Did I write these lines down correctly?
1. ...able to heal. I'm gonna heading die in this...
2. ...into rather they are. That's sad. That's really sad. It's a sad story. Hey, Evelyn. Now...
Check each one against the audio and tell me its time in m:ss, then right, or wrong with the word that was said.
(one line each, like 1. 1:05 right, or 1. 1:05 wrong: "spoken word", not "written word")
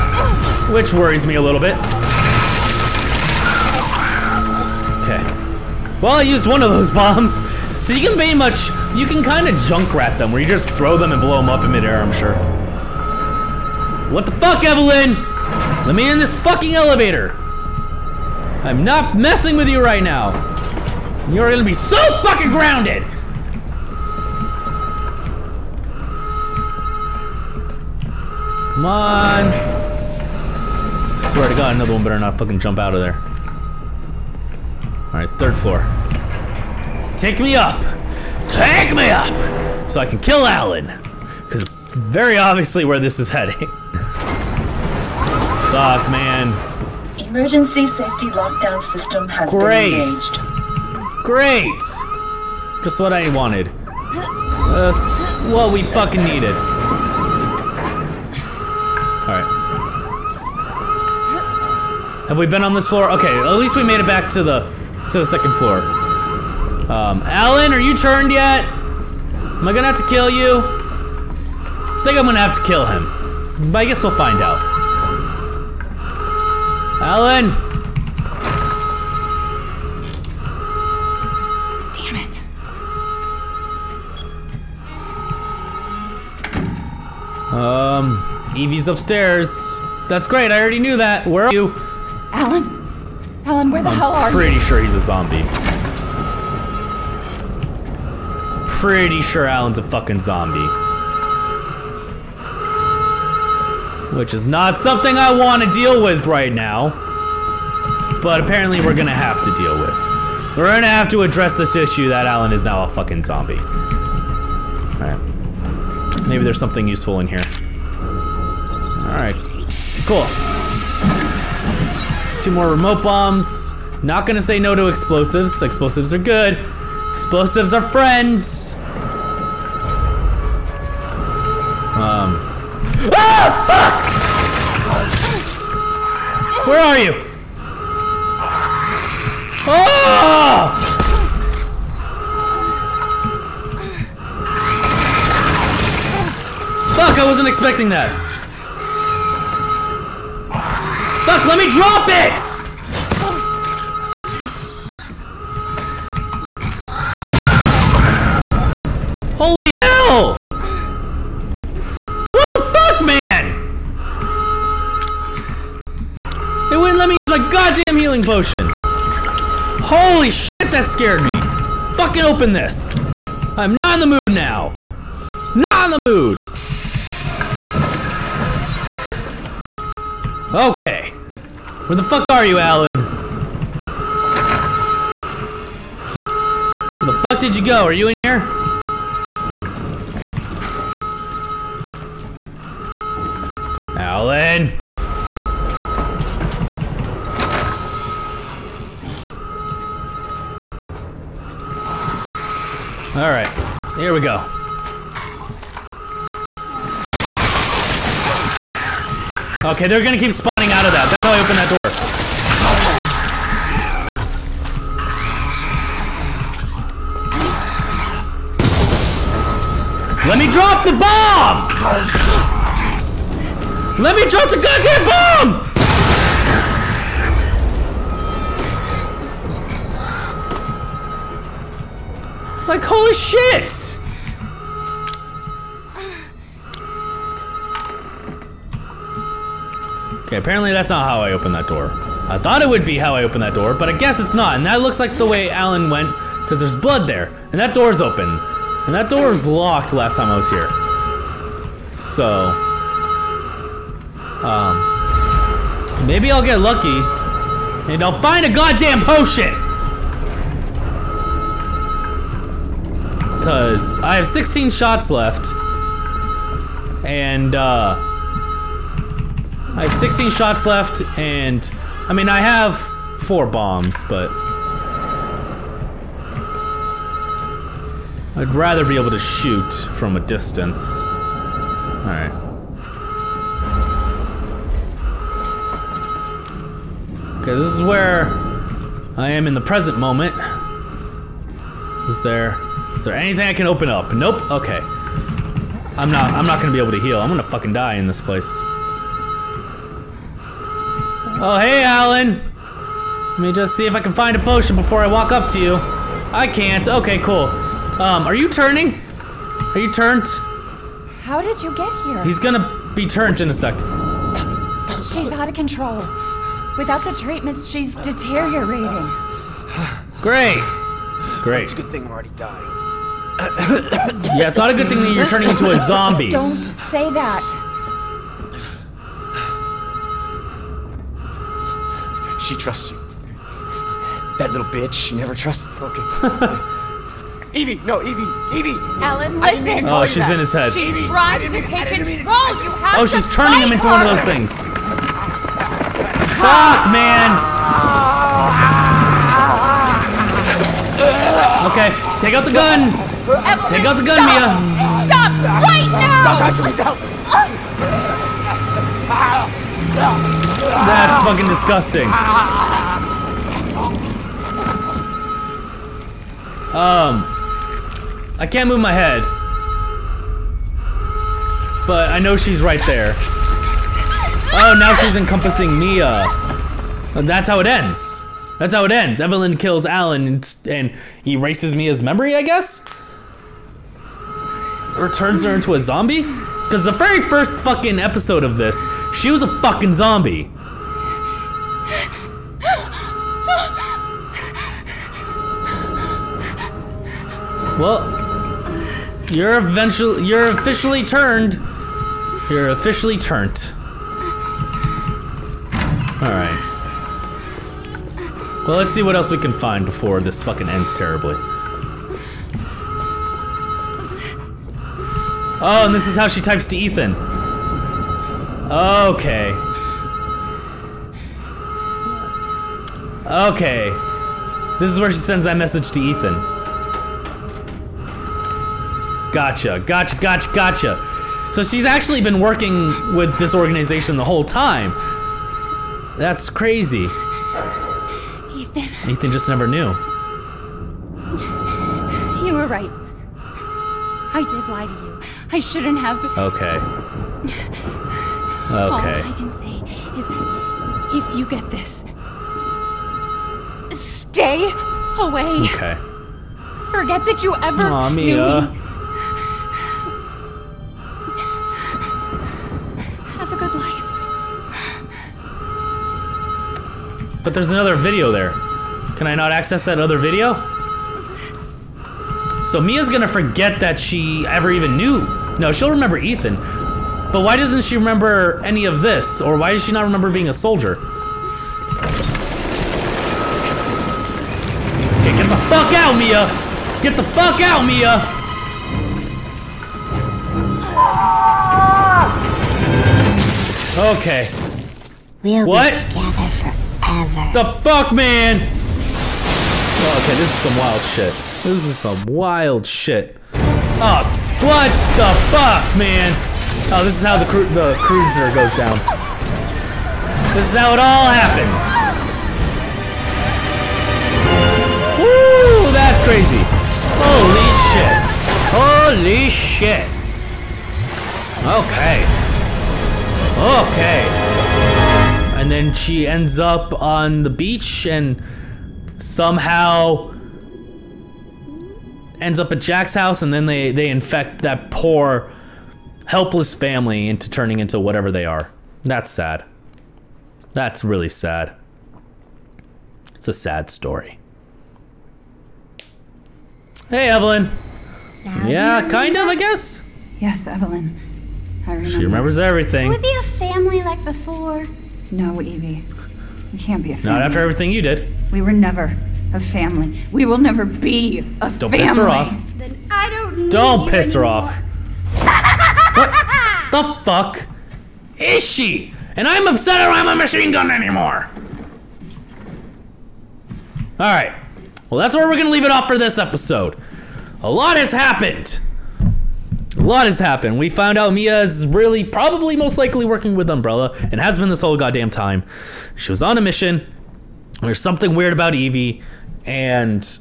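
1. 4:56 wrong: "fucking", not "heading"
2. 8:57 wrong: "whatever", not "rather".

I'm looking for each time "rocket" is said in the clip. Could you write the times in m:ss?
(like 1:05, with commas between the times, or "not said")
not said.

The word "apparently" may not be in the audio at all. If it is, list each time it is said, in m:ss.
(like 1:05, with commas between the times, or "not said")
1:48, 4:00.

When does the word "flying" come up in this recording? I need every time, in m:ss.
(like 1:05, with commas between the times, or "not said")
not said.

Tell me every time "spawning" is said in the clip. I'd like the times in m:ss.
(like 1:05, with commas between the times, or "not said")
3:30.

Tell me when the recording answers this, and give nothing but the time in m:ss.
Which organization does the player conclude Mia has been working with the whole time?
9:43.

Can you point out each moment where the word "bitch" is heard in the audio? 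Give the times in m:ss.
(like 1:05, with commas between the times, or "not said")
5:34.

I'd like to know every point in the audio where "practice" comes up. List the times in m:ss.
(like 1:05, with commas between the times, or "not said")
not said.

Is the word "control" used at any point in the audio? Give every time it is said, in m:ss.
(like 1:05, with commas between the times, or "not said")
5:15, 5:41.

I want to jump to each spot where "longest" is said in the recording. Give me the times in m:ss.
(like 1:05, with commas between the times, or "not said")
not said.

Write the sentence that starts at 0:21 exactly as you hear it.
You're gonna be so fucking grounded.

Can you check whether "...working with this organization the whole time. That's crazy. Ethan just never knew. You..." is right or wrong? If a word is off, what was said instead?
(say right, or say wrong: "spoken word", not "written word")
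right.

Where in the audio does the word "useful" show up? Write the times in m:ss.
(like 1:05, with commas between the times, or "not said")
1:56.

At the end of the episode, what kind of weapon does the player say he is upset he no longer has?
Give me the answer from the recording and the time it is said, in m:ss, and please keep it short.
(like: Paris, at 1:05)
machine gun, at 9:30.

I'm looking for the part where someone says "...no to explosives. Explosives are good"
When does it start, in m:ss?
2:04.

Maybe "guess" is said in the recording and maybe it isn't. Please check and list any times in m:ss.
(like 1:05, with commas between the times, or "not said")
1:13, 4:03, 6:22, 9:09.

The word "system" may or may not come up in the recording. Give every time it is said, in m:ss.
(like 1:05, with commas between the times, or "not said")
0:48.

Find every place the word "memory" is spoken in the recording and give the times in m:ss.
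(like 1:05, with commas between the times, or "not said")
6:22.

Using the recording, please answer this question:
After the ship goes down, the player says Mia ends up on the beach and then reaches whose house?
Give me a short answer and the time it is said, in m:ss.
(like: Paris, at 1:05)
Jack's house, at 8:52.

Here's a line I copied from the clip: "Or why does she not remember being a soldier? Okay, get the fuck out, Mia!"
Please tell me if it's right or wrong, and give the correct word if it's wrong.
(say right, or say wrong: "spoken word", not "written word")
right.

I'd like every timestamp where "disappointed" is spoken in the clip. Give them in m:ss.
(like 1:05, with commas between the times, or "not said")
not said.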